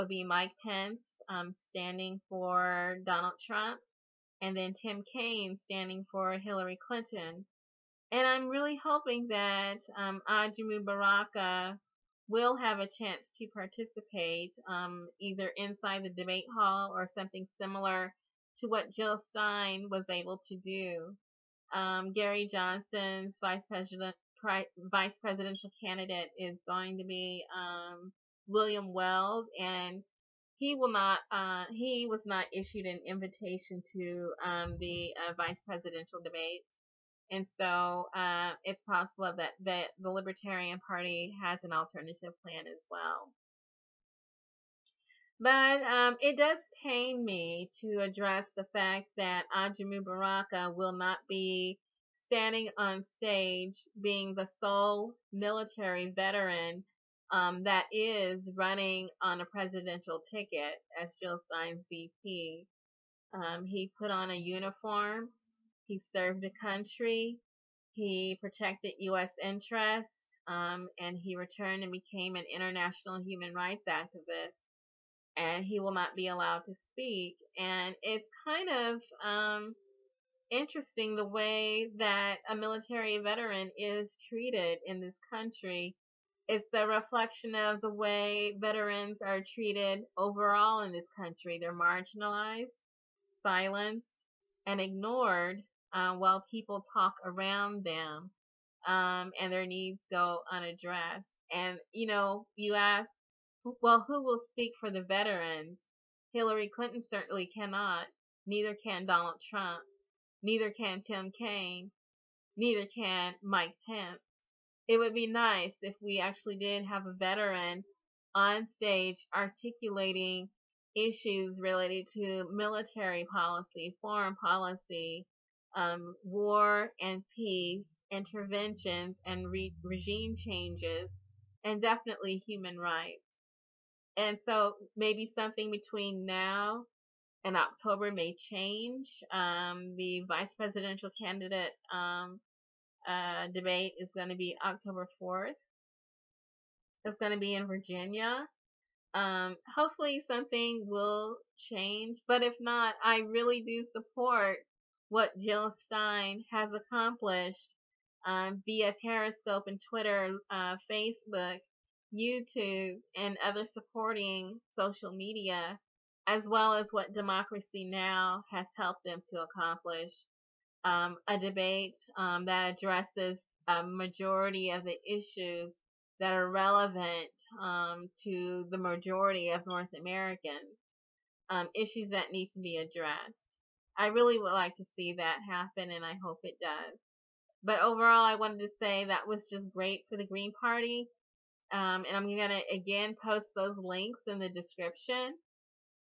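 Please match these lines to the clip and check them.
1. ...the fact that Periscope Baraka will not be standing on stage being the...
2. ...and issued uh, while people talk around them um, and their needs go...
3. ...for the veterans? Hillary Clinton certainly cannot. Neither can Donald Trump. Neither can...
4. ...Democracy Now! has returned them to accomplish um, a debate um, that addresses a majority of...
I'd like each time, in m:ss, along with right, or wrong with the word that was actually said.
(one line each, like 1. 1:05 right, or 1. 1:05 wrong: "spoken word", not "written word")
1. 0:48 wrong: "Ajamu", not "Periscope"
2. 1:34 wrong: "ignored", not "issued"
3. 1:44 right
4. 2:47 wrong: "helped", not "returned".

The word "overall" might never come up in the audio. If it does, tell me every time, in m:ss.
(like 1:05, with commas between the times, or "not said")
1:30, 3:07.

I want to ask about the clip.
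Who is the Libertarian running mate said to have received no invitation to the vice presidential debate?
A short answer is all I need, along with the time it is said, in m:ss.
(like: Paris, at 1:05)
William Weld, at 0:28.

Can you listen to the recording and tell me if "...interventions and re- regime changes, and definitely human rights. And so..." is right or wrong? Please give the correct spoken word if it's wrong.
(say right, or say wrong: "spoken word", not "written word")
right.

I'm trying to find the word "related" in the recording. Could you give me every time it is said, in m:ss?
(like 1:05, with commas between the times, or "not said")
2:01.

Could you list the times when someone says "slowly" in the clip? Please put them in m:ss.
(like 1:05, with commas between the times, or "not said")
not said.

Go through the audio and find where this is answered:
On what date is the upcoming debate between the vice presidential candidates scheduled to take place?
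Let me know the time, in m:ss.
2:24.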